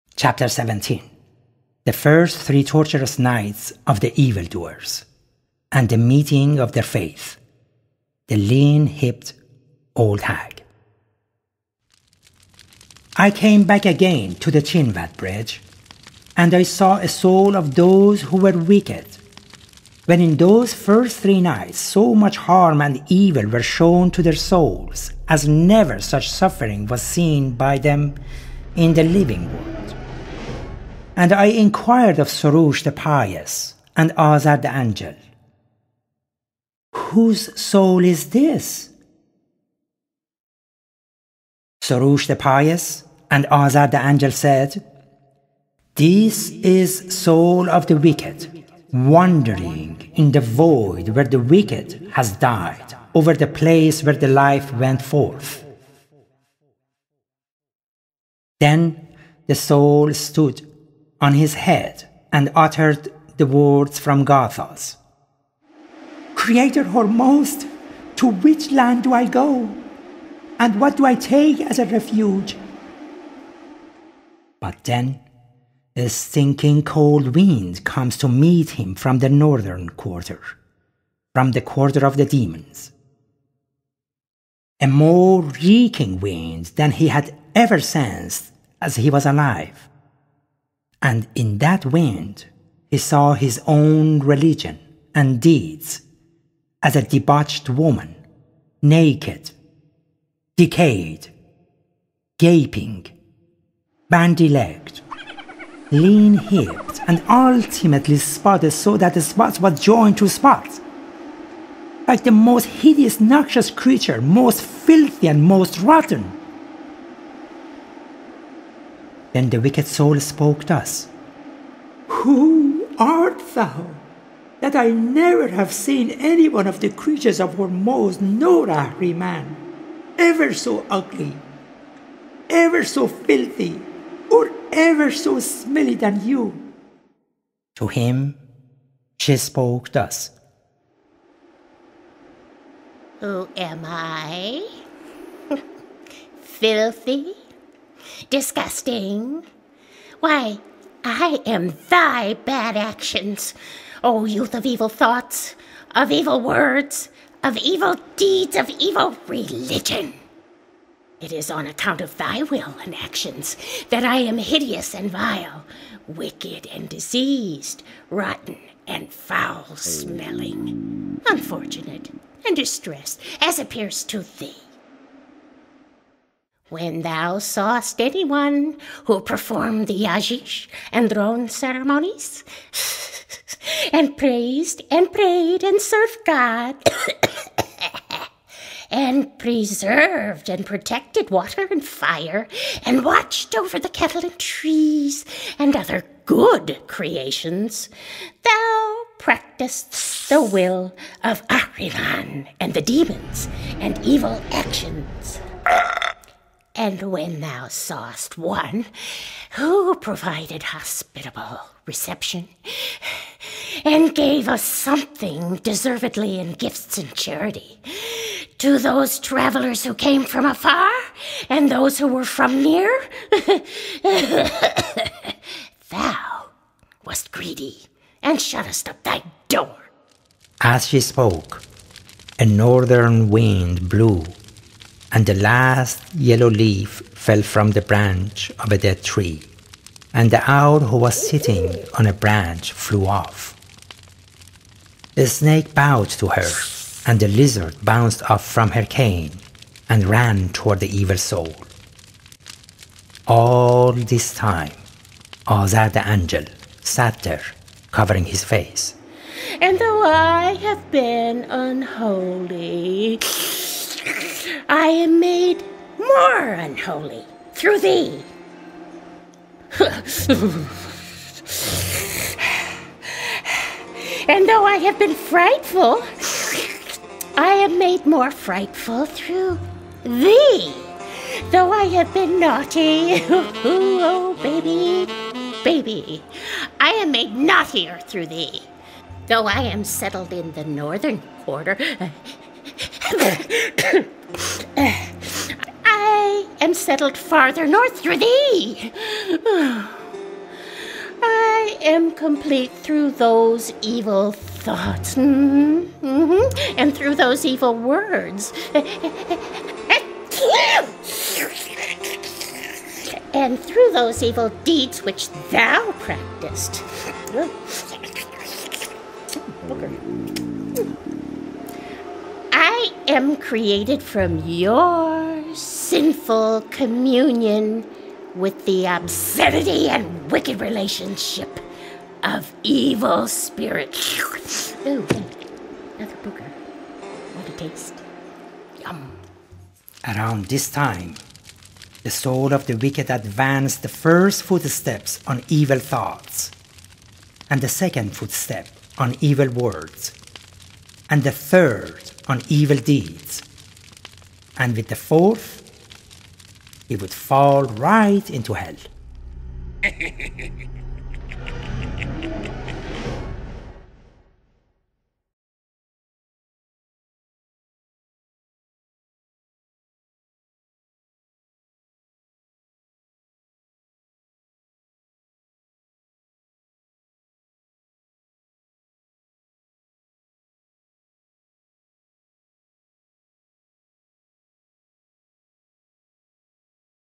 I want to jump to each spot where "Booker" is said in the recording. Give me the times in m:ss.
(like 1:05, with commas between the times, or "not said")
5:19.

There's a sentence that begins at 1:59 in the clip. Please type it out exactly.
Then the wicked soul spoke thus Who art thou?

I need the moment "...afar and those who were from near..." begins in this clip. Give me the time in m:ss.
3:40.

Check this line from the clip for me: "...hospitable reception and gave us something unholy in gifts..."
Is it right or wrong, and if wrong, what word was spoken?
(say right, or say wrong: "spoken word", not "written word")
wrong: "deservedly", not "unholy".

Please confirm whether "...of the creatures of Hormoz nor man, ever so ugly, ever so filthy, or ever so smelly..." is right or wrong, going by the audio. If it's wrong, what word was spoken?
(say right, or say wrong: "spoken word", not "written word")
right.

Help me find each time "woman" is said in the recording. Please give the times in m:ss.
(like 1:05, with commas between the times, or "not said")
1:37.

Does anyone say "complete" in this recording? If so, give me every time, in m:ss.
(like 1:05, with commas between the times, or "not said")
5:02.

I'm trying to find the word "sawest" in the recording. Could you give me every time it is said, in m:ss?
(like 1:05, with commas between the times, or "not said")
2:57, 3:27.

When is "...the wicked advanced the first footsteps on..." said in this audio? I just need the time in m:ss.
5:42.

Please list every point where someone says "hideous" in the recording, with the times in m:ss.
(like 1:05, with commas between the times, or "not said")
1:52, 2:44.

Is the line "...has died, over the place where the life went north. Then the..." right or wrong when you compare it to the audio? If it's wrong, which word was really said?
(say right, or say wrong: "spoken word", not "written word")
wrong: "forth", not "north".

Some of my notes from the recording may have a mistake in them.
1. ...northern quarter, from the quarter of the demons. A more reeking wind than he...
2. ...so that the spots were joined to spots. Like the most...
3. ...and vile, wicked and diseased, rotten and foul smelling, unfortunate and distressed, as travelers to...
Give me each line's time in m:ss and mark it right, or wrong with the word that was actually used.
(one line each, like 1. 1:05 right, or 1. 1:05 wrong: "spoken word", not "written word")
1. 1:19 right
2. 1:48 right
3. 2:44 wrong: "appears", not "travelers".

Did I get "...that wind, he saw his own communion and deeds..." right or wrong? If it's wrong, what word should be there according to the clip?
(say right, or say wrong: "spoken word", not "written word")
wrong: "religion", not "communion".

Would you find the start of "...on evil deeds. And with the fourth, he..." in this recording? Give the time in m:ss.
5:52.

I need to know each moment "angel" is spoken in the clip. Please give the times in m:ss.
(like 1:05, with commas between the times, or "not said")
0:34, 0:44, 4:16.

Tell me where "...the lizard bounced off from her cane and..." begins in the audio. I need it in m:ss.
4:07.